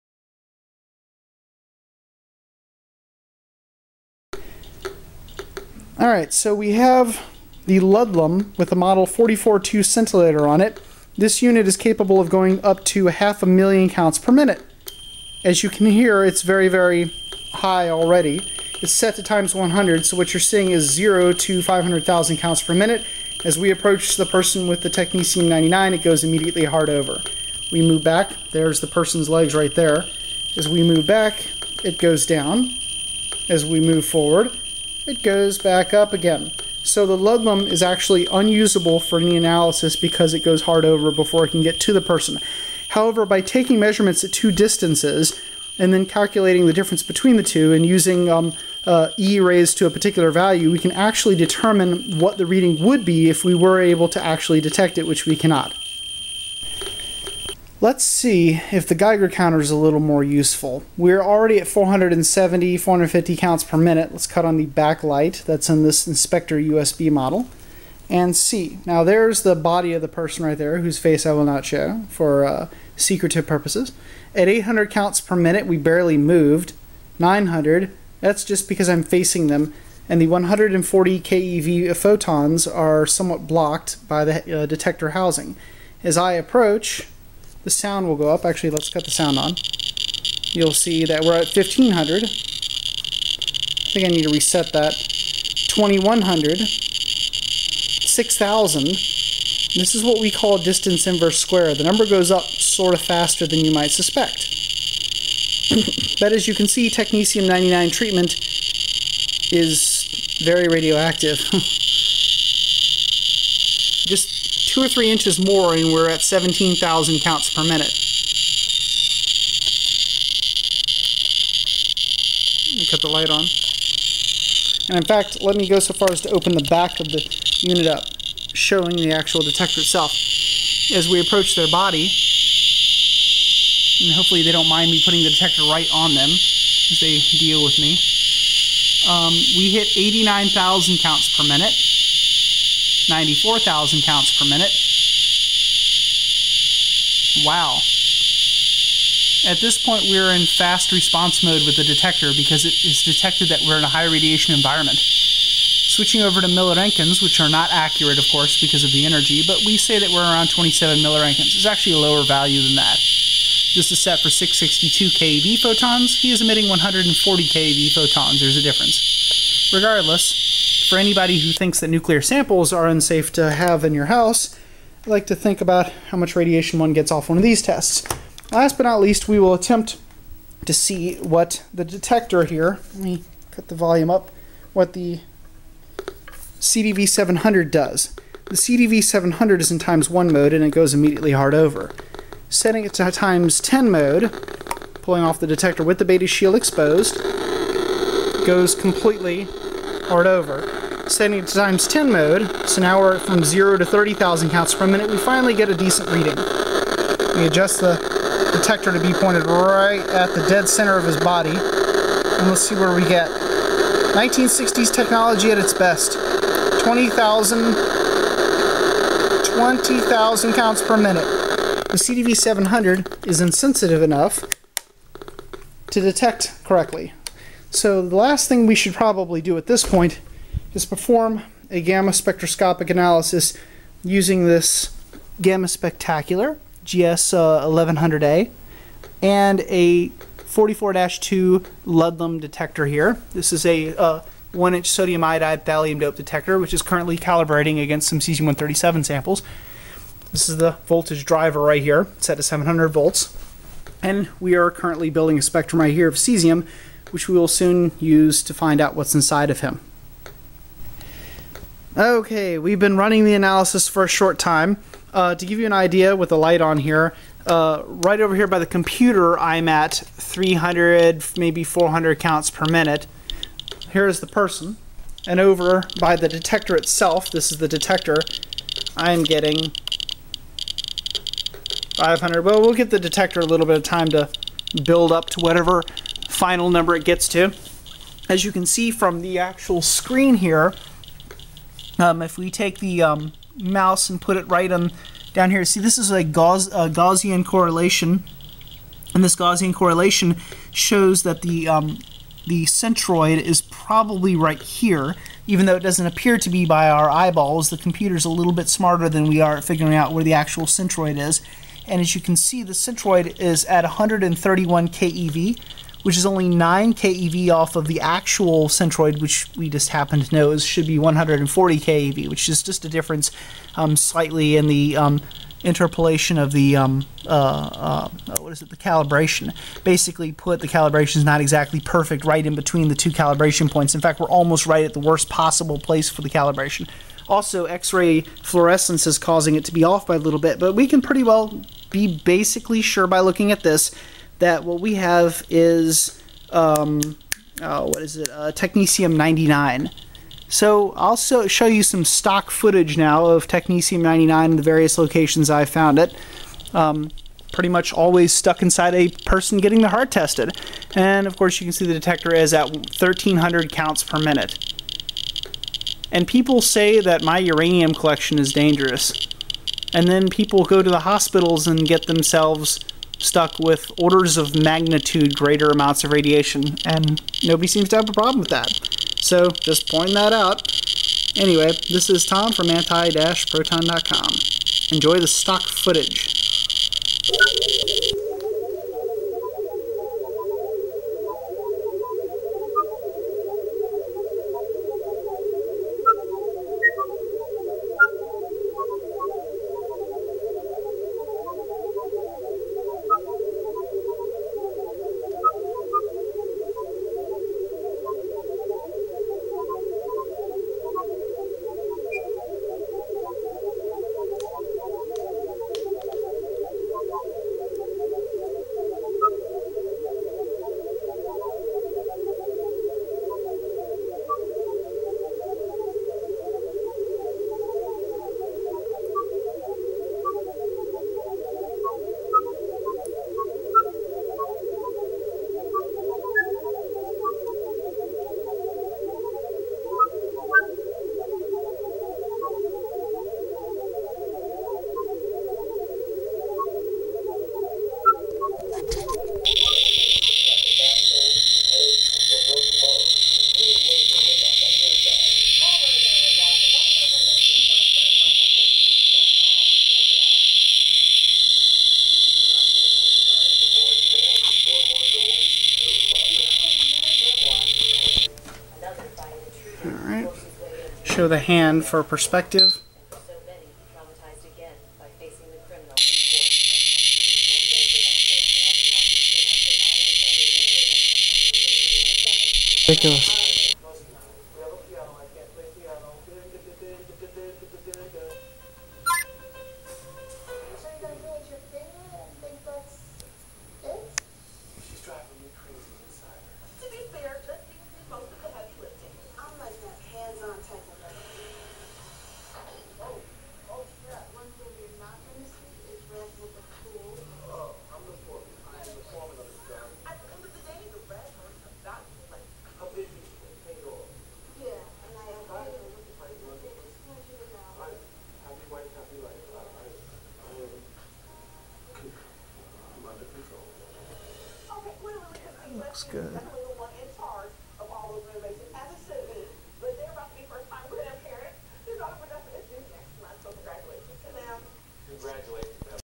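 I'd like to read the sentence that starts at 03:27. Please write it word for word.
We adjust the detector to be pointed right at the dead center of his body, and let's see where we get.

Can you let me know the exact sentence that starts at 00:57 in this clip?
Let's see if the Geiger counter is a little more useful.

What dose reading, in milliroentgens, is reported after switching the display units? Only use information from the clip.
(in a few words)
27.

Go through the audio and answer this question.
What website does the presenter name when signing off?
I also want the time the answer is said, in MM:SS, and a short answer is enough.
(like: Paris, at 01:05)
anti-proton.com, at 06:22.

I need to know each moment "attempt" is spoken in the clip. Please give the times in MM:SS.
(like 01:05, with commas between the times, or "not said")
02:59.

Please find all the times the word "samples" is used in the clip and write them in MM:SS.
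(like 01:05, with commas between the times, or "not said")
02:52, 04:09.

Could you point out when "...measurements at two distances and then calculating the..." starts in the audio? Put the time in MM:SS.
00:43.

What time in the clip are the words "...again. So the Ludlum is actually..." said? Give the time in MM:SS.
00:36.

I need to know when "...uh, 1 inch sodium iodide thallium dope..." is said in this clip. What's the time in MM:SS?
04:03.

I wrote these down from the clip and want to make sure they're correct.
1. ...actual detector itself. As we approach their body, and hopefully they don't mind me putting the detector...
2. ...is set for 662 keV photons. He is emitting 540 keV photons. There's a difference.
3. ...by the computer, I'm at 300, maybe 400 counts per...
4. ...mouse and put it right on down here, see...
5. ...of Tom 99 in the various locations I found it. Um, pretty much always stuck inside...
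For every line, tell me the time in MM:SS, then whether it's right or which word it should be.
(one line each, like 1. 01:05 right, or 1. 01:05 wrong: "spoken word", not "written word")
1. 02:09 right
2. 02:43 wrong: "140", not "540"
3. 04:28 right
4. 04:53 right
5. 05:53 wrong: "Technetium", not "Tom".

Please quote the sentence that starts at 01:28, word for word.
Actually, let's cut the sound on.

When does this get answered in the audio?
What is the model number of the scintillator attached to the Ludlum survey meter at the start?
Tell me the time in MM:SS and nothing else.
00:08.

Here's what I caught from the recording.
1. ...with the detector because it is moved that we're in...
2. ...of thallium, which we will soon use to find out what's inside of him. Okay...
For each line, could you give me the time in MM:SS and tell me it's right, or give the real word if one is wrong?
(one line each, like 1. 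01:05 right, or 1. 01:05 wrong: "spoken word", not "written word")
1. 02:31 wrong: "detected", not "moved"
2. 04:16 wrong: "cesium", not "thallium".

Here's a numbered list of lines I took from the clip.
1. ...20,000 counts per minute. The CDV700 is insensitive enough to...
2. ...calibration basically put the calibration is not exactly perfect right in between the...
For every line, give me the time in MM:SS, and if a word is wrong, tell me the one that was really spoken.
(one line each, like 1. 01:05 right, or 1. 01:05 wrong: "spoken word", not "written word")
1. 03:39 right
2. 05:28 right.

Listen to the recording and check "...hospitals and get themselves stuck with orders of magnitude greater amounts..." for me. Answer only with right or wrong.
right.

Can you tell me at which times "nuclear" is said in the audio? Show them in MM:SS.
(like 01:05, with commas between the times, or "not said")
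02:51.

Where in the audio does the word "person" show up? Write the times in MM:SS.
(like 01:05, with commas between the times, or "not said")
00:24, 00:28, 00:42, 01:10, 04:34, 05:59.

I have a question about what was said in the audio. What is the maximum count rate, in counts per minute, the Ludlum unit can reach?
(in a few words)
half a million.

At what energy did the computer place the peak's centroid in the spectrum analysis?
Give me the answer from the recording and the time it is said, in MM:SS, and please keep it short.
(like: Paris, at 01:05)
131 keV, at 05:13.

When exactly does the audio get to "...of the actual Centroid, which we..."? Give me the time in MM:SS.
05:17.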